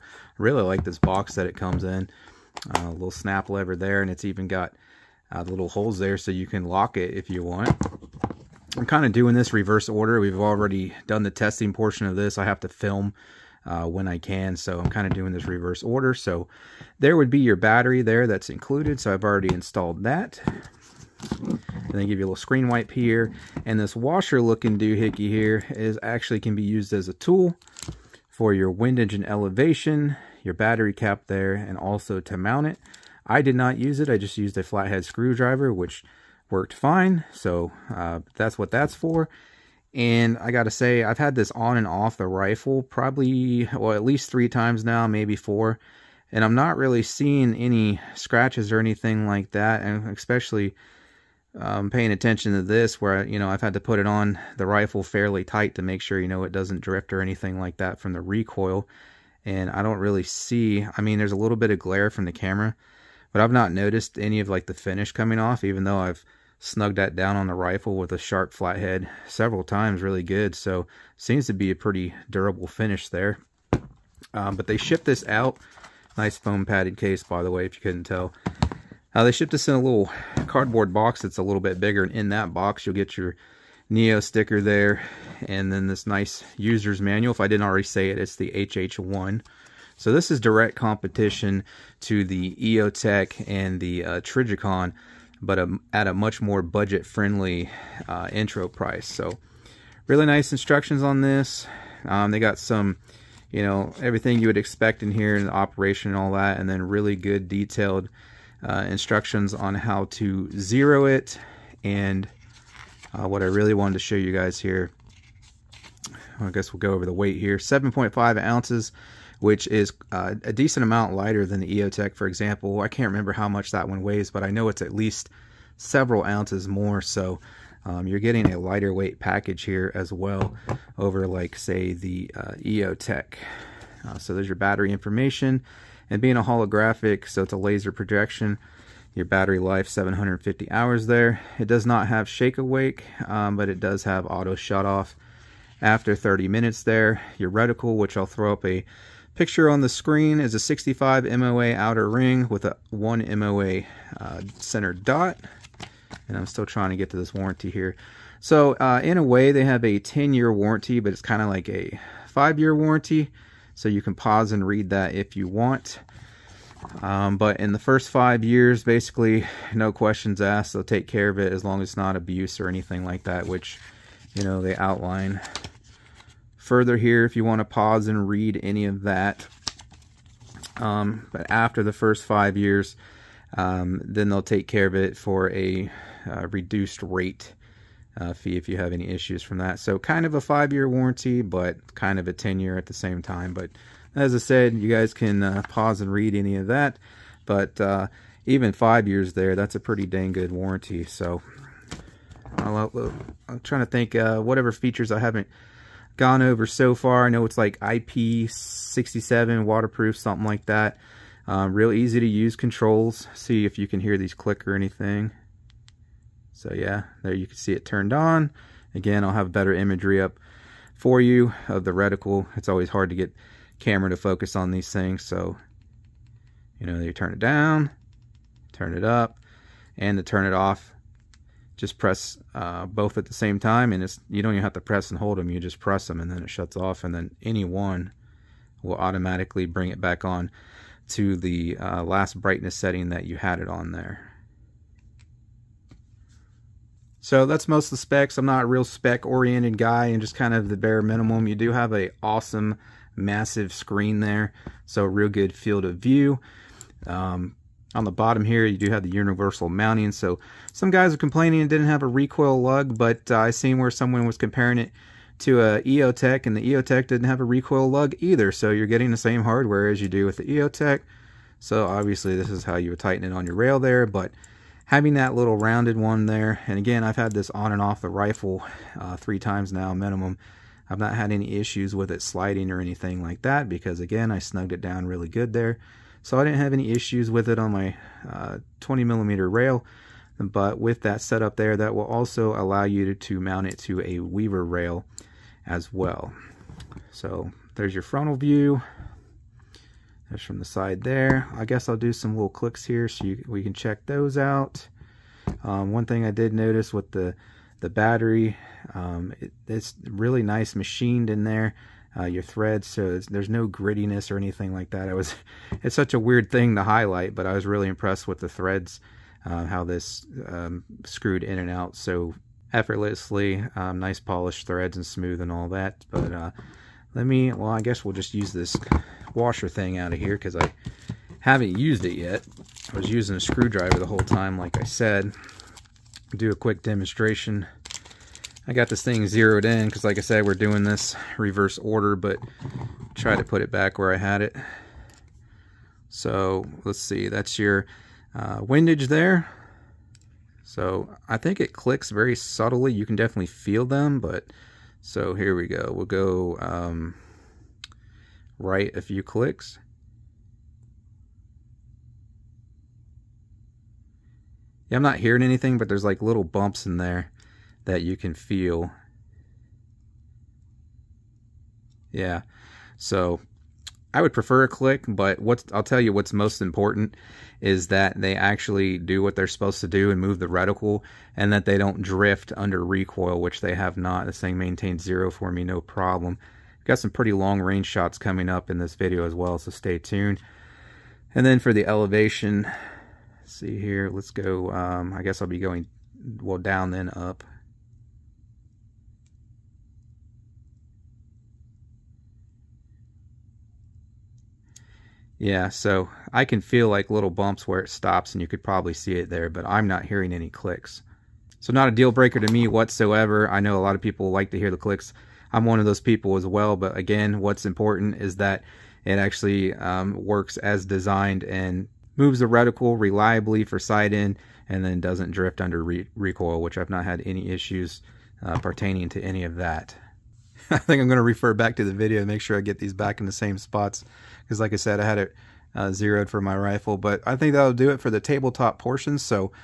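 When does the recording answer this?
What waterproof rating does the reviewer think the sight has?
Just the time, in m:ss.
3:27.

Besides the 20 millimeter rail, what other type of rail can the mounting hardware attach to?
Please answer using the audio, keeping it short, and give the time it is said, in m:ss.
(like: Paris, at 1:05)
Weaver rail, at 4:54.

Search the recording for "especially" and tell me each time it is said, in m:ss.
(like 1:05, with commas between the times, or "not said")
0:50.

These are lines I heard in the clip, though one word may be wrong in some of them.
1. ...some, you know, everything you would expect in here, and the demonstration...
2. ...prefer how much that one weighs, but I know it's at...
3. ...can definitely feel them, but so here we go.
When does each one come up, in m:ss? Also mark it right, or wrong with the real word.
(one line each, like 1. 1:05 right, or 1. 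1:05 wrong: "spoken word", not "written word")
1. 1:42 wrong: "operation", not "demonstration"
2. 2:03 wrong: "remember", not "prefer"
3. 5:53 right.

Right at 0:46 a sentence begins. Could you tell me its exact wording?
And I'm not really seeing any scratches or anything like that.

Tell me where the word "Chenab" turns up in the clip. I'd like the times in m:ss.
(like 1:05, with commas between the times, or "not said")
not said.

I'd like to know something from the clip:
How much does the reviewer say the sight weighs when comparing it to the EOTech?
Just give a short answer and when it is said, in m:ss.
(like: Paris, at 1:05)
7.5 ounces, at 1:57.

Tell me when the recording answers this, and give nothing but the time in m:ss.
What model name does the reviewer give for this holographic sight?
1:28.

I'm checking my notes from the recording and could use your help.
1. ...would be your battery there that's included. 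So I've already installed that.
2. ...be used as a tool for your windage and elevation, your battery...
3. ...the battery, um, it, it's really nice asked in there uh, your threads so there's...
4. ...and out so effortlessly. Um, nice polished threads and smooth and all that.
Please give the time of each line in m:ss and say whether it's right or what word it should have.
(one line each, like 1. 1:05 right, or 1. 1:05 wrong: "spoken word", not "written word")
1. 0:17 right
2. 0:26 right
3. 5:07 wrong: "machined", not "asked"
4. 5:21 right.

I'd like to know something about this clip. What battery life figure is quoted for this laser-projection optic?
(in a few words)
750 hours.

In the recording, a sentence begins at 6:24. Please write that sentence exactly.
This thing maintains zero for me, no problem.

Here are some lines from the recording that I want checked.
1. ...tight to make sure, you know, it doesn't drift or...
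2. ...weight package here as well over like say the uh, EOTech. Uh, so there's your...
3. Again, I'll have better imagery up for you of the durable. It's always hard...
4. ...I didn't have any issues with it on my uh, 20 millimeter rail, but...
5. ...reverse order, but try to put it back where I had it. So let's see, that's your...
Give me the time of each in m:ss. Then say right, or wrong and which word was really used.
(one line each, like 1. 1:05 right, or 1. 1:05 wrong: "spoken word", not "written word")
1. 0:55 right
2. 2:08 right
3. 3:38 wrong: "reticle", not "durable"
4. 4:46 right
5. 5:41 right.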